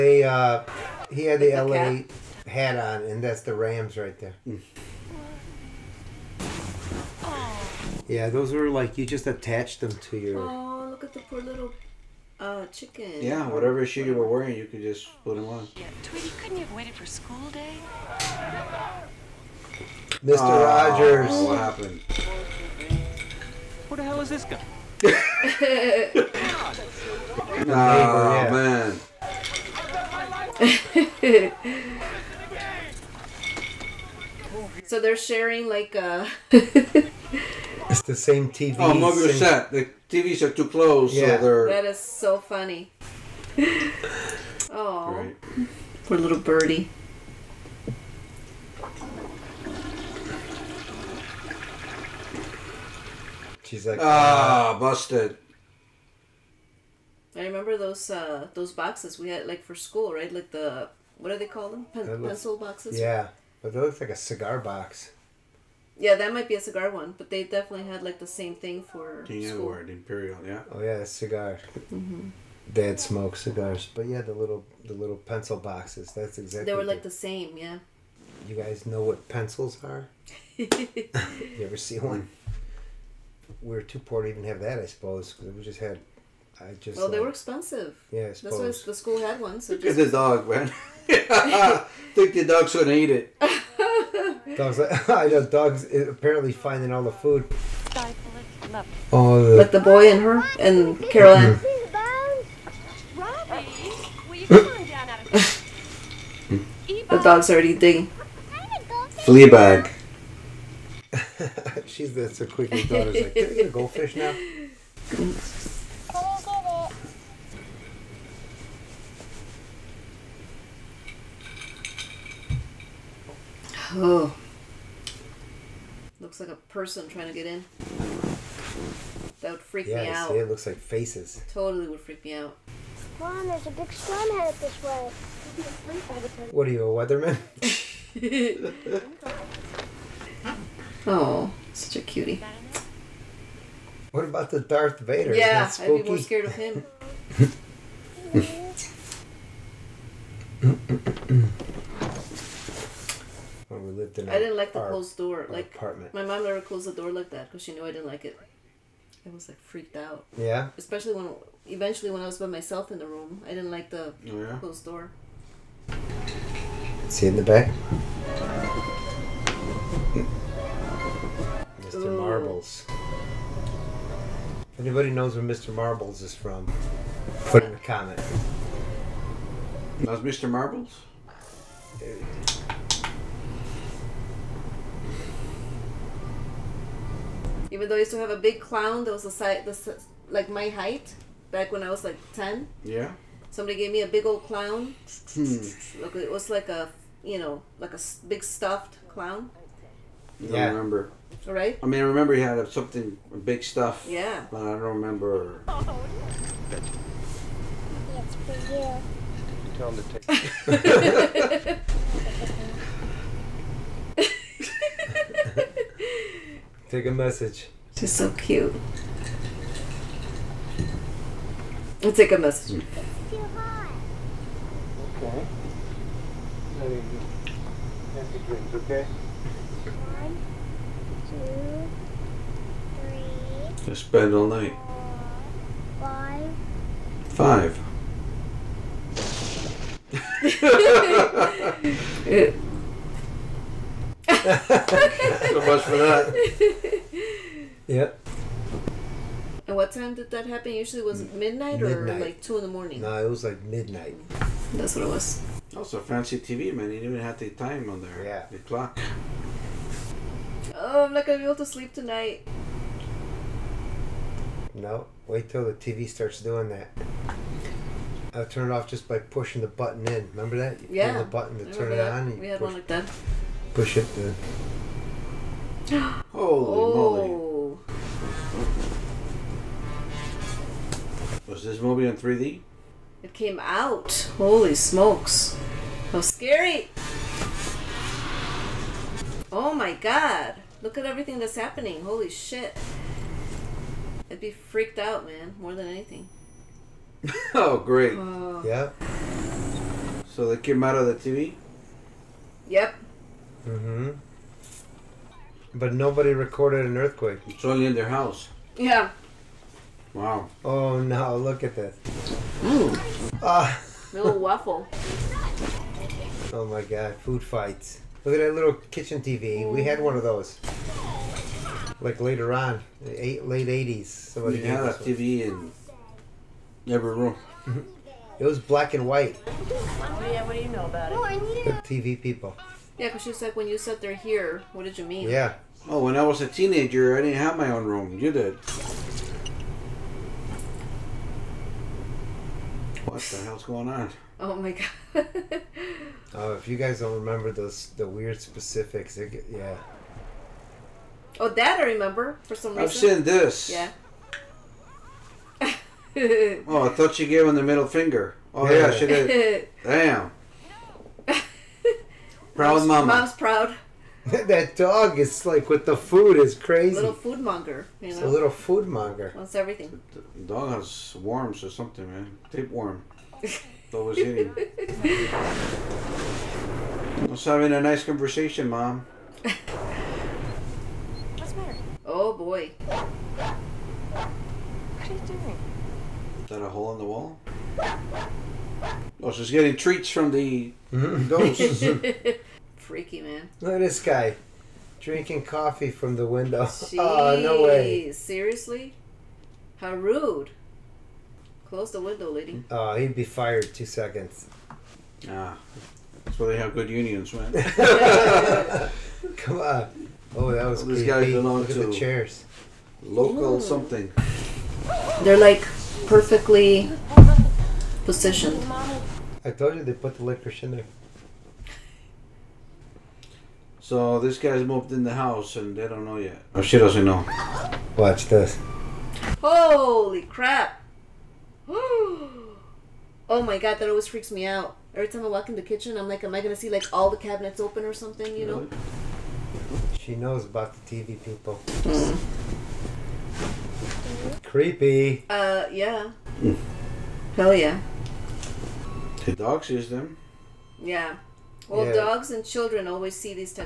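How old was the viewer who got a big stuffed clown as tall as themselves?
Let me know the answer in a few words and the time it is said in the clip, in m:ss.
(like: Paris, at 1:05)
10, at 3:12.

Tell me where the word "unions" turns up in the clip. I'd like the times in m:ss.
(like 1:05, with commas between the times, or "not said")
6:46.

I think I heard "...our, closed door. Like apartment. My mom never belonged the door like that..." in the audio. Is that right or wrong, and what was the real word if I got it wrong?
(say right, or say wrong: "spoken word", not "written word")
wrong: "closed", not "belonged".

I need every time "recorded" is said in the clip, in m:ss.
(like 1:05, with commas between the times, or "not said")
5:06.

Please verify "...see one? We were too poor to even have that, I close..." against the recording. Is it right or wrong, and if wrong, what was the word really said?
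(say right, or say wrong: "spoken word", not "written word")
wrong: "suppose", not "close".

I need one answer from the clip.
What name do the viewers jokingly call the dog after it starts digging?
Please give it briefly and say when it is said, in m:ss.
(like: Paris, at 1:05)
Fleabag, at 1:49.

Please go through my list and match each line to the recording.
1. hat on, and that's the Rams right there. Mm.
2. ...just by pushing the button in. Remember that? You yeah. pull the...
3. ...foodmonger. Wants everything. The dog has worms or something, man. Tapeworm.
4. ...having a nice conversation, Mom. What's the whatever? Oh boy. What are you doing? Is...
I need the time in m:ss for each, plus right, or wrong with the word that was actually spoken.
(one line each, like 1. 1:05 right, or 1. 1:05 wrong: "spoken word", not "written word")
1. 0:02 right
2. 4:28 right
3. 6:08 right
4. 6:17 wrong: "matter", not "whatever".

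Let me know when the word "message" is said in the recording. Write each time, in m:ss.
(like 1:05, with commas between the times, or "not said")
3:37, 3:42.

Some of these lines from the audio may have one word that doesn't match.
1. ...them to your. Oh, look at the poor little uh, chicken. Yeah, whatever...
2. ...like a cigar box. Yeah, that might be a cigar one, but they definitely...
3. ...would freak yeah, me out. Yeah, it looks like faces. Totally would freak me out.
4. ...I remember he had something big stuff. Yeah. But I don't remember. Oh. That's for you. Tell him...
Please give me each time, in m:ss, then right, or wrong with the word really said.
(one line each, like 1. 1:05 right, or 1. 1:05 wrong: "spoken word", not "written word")
1. 0:09 right
2. 1:03 right
3. 2:09 right
4. 3:22 right.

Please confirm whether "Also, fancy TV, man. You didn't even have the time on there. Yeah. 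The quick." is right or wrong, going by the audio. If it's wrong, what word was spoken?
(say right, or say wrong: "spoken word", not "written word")
wrong: "clock", not "quick".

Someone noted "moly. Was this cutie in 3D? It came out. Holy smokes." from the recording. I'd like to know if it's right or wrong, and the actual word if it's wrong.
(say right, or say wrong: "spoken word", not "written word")
wrong: "movie", not "cutie".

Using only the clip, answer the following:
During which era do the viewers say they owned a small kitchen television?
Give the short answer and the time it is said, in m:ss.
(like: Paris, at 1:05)
Late '80s, at 5:23.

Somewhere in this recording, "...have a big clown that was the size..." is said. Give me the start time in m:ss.
3:08.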